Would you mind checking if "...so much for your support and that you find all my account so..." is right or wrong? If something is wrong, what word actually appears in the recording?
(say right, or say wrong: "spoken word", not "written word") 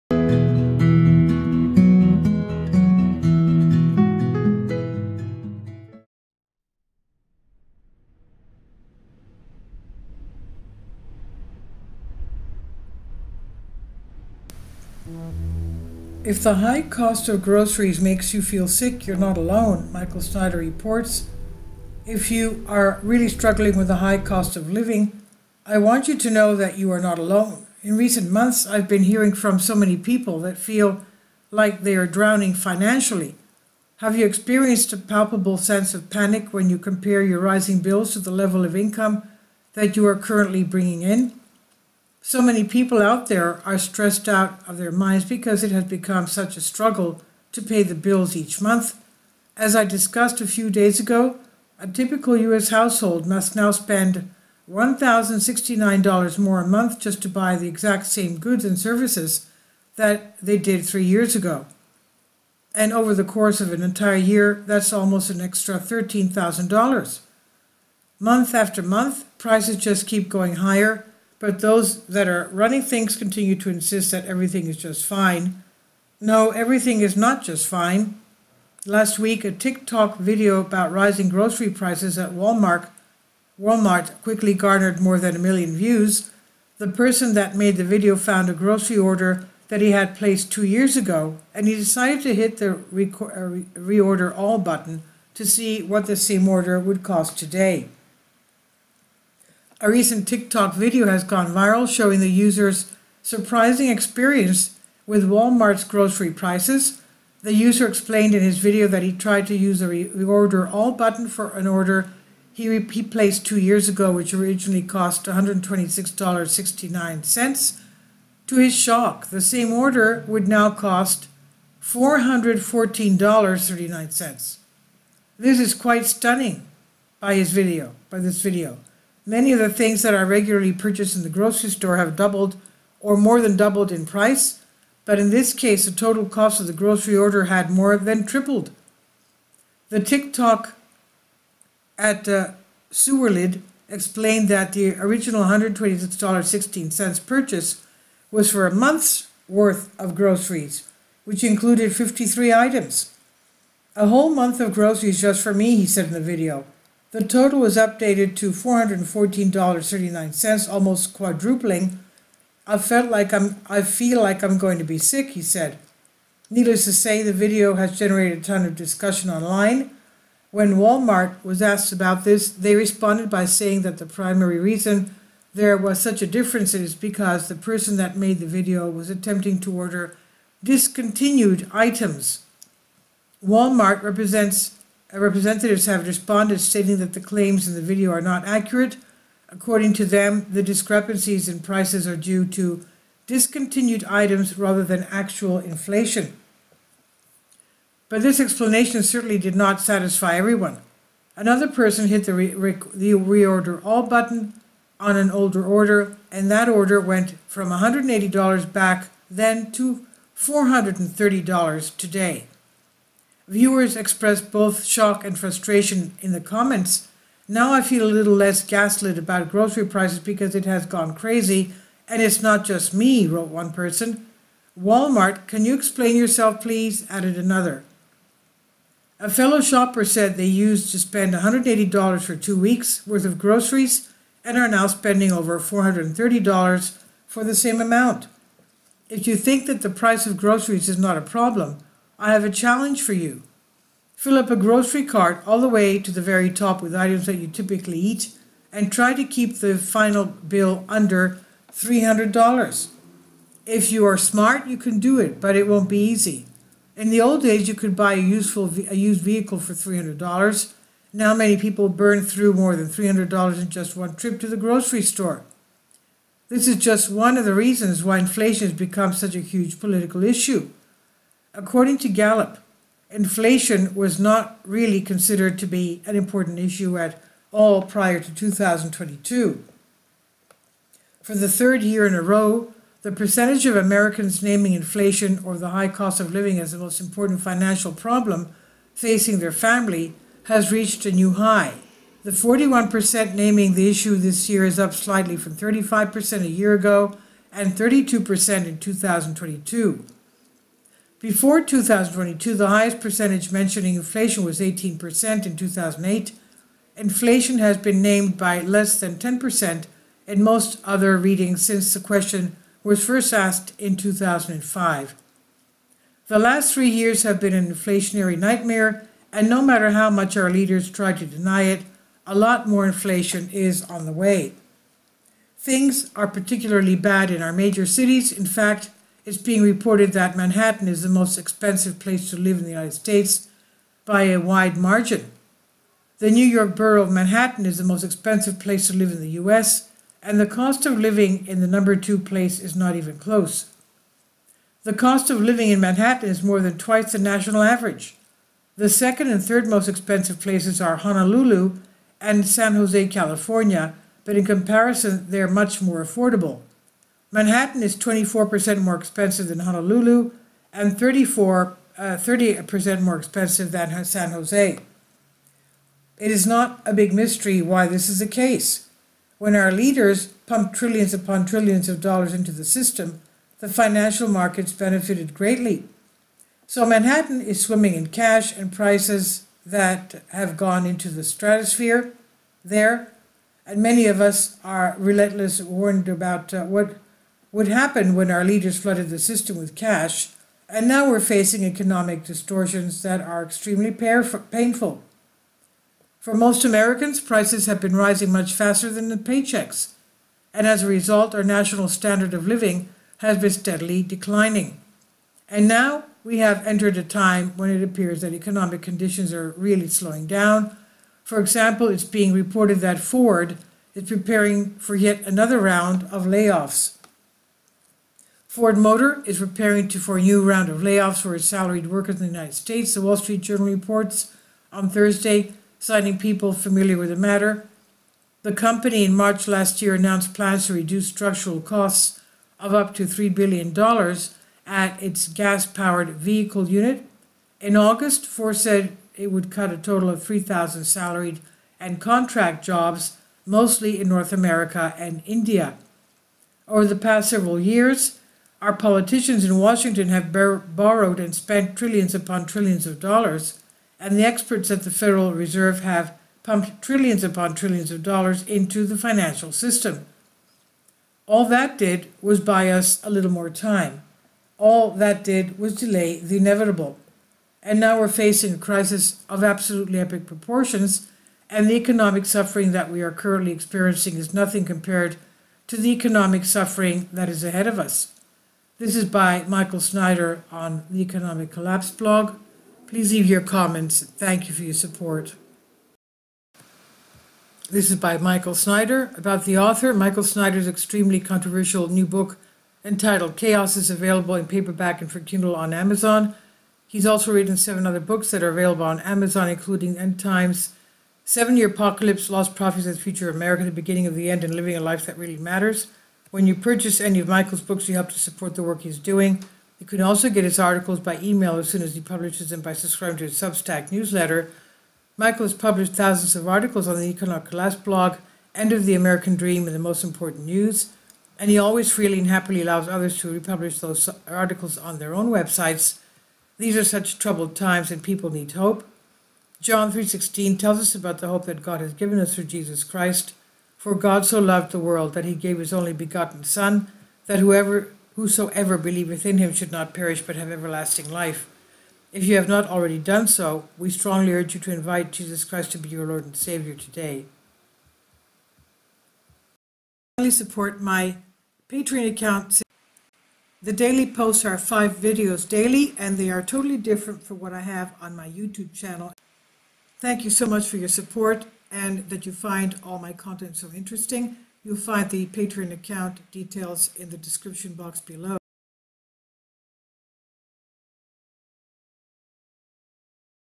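wrong: "content", not "account".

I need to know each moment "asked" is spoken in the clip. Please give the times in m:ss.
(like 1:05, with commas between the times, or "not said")
2:51, 5:13.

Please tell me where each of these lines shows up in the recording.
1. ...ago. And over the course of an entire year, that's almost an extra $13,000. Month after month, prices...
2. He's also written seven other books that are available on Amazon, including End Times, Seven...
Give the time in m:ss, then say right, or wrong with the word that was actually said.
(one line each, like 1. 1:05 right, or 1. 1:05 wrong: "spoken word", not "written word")
1. 1:01 right
2. 8:16 right.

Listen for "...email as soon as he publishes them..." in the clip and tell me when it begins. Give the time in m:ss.
8:31.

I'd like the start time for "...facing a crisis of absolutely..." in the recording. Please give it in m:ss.
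7:48.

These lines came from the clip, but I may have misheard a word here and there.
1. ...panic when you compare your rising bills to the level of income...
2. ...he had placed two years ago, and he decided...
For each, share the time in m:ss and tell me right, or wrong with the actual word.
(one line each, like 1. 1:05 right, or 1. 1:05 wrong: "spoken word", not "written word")
1. 0:36 right
2. 1:29 right.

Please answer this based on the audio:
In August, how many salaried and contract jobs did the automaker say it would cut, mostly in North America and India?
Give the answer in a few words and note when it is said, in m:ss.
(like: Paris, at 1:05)
3,000, at 7:20.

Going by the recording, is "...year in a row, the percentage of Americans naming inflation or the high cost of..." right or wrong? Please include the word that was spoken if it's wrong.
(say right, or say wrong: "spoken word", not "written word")
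right.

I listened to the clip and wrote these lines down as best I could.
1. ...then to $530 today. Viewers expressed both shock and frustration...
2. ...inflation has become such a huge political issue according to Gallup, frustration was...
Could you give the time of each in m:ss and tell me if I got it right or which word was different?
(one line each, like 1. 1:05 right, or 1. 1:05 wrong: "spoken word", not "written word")
1. 3:29 wrong: "430", not "530"
2. 4:28 wrong: "inflation", not "frustration".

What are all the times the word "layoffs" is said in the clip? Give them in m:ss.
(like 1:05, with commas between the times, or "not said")
6:56, 7:00.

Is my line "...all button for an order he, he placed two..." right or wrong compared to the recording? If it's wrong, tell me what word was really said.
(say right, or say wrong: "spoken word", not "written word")
right.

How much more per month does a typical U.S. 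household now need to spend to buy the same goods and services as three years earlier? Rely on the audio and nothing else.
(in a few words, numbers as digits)
$1,069.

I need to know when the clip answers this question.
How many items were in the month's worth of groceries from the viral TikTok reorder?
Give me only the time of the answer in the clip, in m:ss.
2:31.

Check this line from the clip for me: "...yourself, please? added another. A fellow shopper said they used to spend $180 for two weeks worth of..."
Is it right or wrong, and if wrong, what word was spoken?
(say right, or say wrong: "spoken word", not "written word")
right.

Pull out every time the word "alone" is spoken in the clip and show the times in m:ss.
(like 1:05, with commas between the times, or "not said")
0:19, 0:27.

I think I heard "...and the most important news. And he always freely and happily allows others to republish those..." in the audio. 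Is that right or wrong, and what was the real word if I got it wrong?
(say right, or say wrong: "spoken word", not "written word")
right.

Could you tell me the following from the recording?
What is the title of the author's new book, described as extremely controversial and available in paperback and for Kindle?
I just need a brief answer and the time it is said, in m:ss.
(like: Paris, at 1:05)
Chaos, at 8:13.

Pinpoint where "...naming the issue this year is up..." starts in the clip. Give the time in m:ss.
4:53.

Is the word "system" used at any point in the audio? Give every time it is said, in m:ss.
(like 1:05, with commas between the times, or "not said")
6:12, 6:29, 7:39.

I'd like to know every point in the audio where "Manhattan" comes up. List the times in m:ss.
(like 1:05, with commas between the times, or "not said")
5:30, 5:37, 5:45, 5:57, 6:16.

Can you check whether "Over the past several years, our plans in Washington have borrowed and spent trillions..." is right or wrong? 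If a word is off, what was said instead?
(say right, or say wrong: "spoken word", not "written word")
wrong: "politicians", not "plans".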